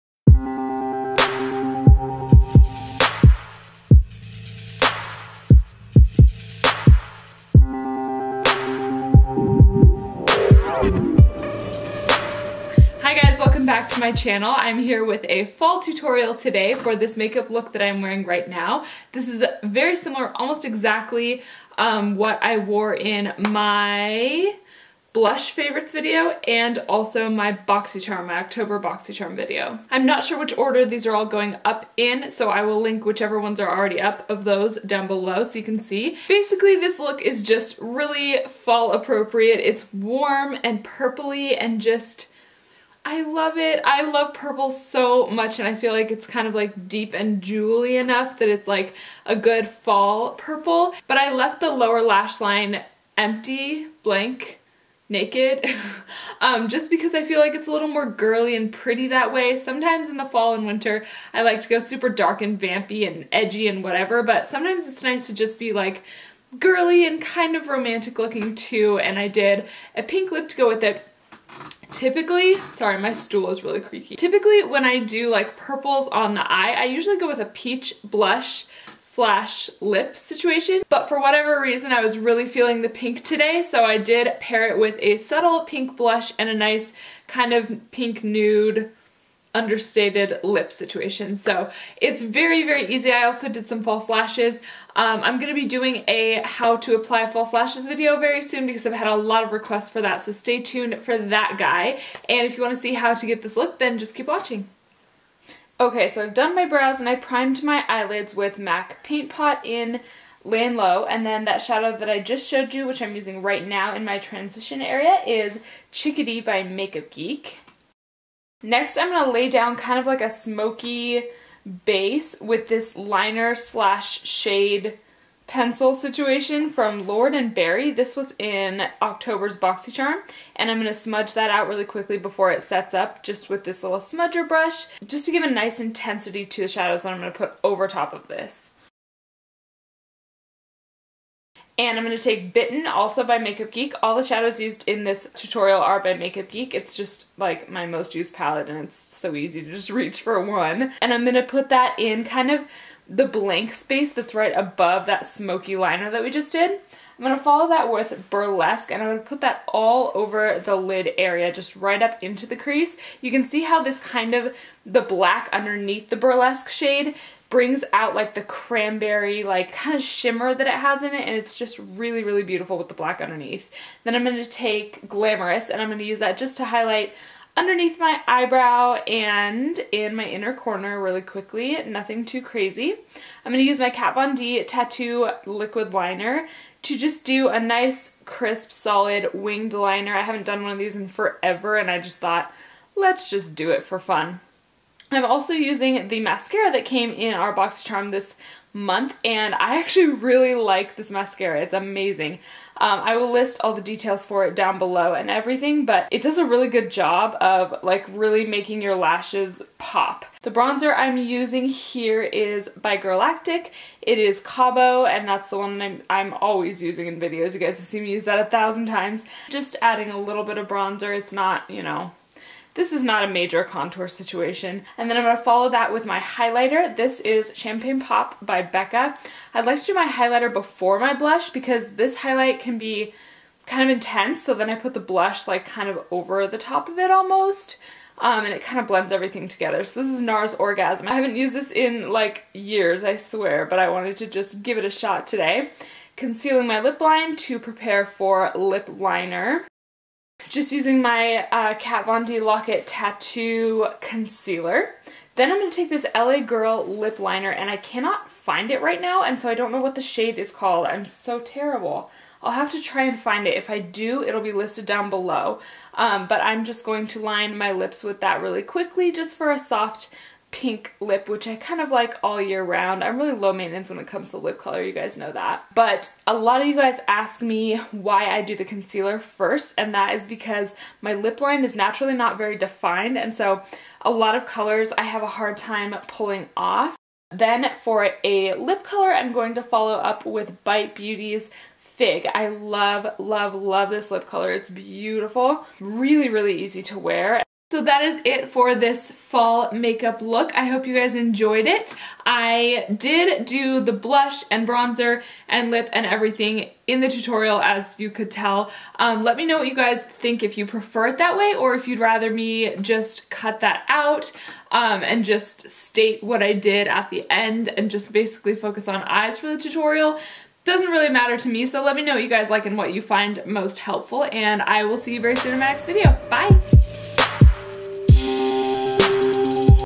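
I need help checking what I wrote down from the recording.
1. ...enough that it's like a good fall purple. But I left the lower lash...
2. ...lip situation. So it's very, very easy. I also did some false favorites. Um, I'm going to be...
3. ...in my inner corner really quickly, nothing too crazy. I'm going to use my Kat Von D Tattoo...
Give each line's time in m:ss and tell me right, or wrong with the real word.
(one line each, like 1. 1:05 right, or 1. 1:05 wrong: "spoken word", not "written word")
1. 0:47 right
2. 1:30 wrong: "lashes", not "favorites"
3. 2:59 right.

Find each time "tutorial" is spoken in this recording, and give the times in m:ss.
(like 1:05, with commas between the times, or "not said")
0:15, 2:25, 5:07, 5:19.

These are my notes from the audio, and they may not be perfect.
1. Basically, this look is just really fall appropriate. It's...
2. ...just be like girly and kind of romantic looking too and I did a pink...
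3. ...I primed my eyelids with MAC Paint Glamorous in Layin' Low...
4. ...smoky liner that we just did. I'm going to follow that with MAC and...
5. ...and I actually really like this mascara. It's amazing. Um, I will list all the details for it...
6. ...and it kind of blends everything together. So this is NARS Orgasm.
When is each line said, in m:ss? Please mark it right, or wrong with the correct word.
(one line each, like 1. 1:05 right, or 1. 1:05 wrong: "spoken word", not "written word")
1. 0:36 right
2. 1:05 right
3. 1:47 wrong: "Pot", not "Glamorous"
4. 2:35 wrong: "Burlesque", not "MAC"
5. 3:19 right
6. 3:58 right.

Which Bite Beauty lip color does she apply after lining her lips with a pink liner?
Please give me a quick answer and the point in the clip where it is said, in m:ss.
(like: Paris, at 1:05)
Fig, at 4:51.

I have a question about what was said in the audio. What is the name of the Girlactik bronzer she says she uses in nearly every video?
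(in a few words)
Cabo.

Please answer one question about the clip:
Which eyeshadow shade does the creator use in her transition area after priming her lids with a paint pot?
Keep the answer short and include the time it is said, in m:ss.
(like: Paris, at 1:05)
Chickadee, at 1:55.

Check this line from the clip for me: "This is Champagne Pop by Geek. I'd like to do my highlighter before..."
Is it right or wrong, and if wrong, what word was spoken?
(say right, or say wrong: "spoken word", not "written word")
wrong: "Becca", not "Geek".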